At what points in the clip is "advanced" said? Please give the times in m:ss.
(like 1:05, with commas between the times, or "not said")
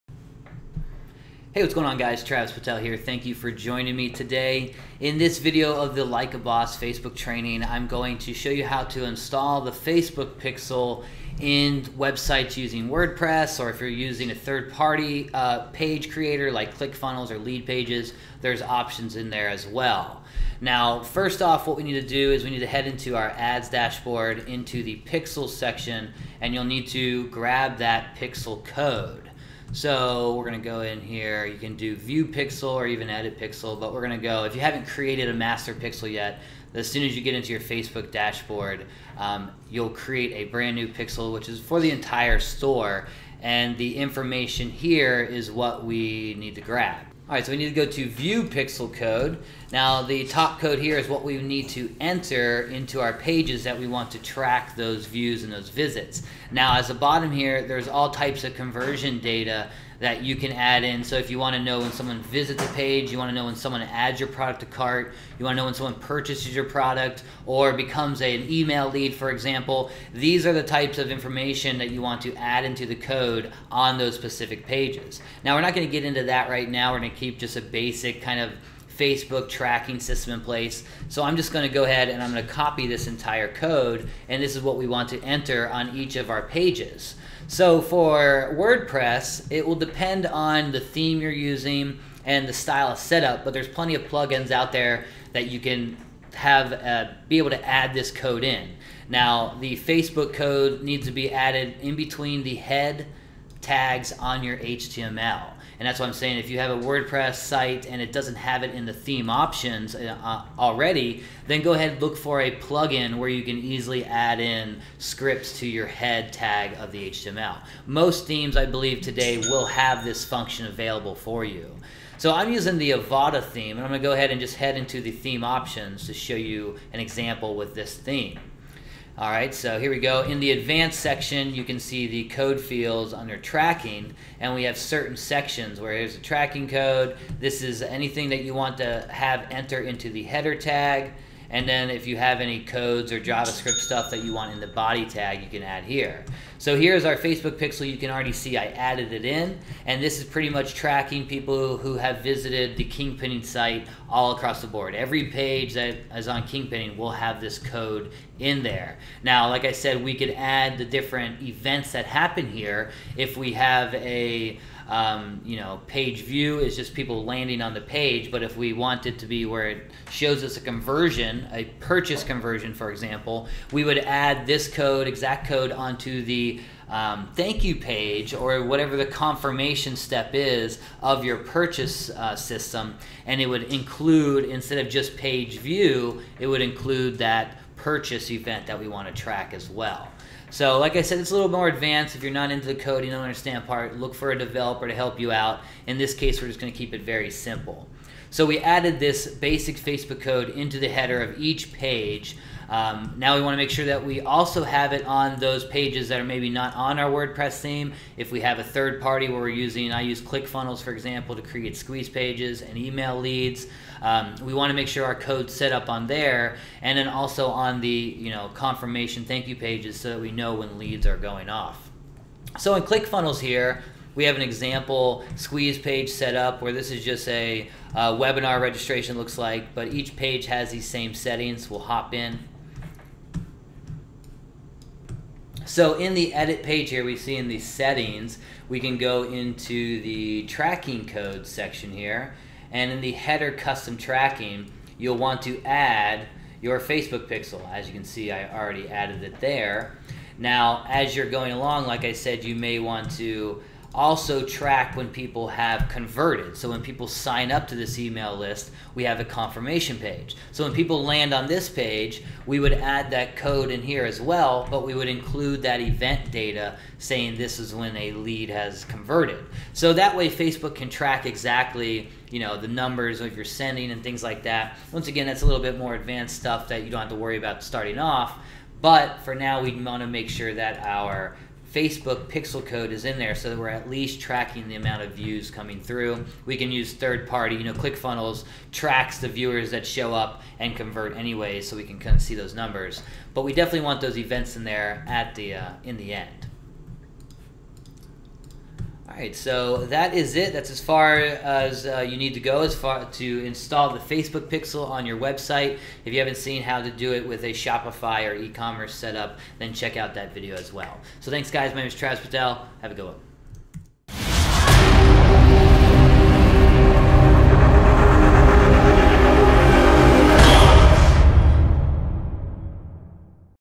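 2:10, 3:11, 4:35.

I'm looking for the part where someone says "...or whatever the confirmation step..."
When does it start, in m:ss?
2:58.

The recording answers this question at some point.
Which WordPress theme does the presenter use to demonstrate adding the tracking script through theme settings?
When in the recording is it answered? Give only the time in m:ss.
2:02.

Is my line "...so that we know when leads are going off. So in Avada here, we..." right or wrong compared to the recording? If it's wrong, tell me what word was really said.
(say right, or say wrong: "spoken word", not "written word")
wrong: "ClickFunnels", not "Avada".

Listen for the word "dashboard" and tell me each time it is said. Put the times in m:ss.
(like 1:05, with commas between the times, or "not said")
0:23, 0:38.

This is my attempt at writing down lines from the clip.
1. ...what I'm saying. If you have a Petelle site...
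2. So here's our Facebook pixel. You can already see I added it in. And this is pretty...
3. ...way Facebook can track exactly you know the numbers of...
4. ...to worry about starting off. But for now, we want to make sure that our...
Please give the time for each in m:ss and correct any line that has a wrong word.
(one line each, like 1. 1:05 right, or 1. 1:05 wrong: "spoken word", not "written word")
1. 1:45 wrong: "WordPress", not "Petelle"
2. 2:26 right
3. 4:30 right
4. 4:37 right.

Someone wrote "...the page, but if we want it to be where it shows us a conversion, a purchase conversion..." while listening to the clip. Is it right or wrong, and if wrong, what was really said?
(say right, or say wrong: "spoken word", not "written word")
right.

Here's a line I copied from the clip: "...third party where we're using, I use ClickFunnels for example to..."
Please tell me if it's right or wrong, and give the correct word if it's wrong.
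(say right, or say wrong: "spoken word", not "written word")
right.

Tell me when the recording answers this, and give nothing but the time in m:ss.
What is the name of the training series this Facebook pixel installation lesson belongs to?
0:06.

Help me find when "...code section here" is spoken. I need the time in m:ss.
4:01.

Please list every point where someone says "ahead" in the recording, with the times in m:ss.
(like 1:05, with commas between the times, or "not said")
1:21, 1:51, 2:04.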